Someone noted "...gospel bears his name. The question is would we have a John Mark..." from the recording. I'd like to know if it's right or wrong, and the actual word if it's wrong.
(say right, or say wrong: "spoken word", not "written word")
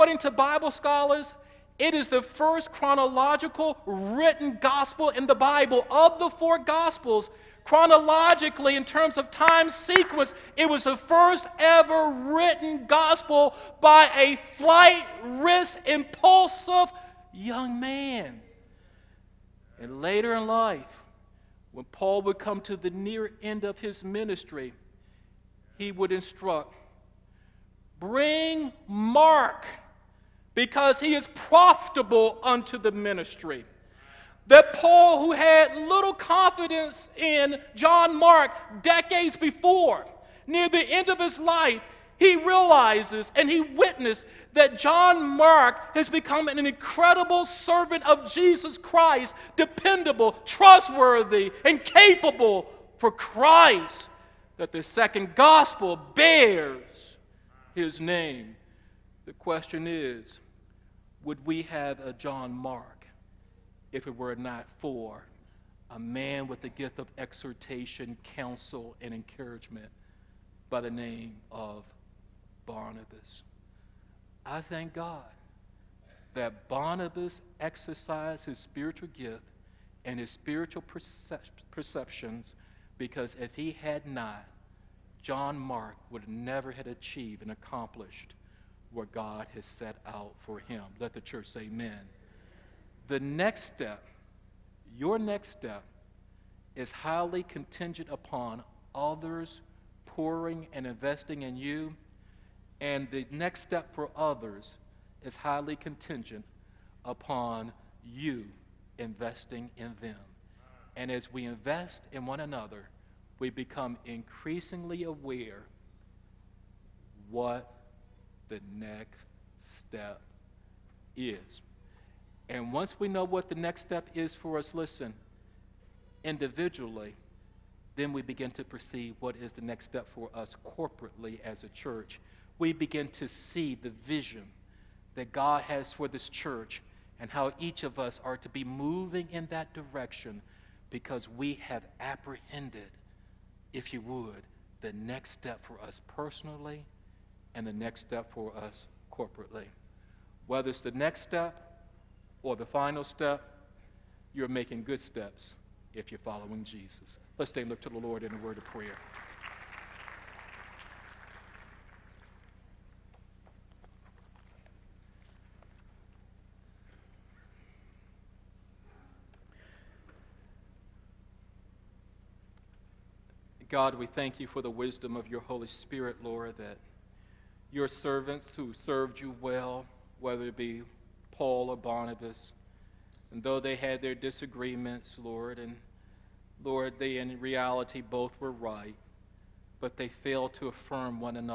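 right.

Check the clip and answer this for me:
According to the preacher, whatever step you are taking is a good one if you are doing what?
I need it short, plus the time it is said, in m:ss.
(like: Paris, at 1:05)
Following Jesus, at 2:36.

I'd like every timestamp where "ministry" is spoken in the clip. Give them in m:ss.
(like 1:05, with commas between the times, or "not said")
0:24, 0:32.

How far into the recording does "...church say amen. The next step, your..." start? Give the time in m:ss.
1:31.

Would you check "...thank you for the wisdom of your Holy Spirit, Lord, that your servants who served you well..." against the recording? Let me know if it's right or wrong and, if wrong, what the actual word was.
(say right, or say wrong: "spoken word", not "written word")
right.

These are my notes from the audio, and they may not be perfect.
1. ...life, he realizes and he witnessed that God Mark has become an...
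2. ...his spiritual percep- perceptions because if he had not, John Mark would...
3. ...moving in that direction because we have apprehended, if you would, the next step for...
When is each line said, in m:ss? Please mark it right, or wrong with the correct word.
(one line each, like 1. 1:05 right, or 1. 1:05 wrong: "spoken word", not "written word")
1. 0:41 wrong: "John", not "God"
2. 1:20 right
3. 2:18 right.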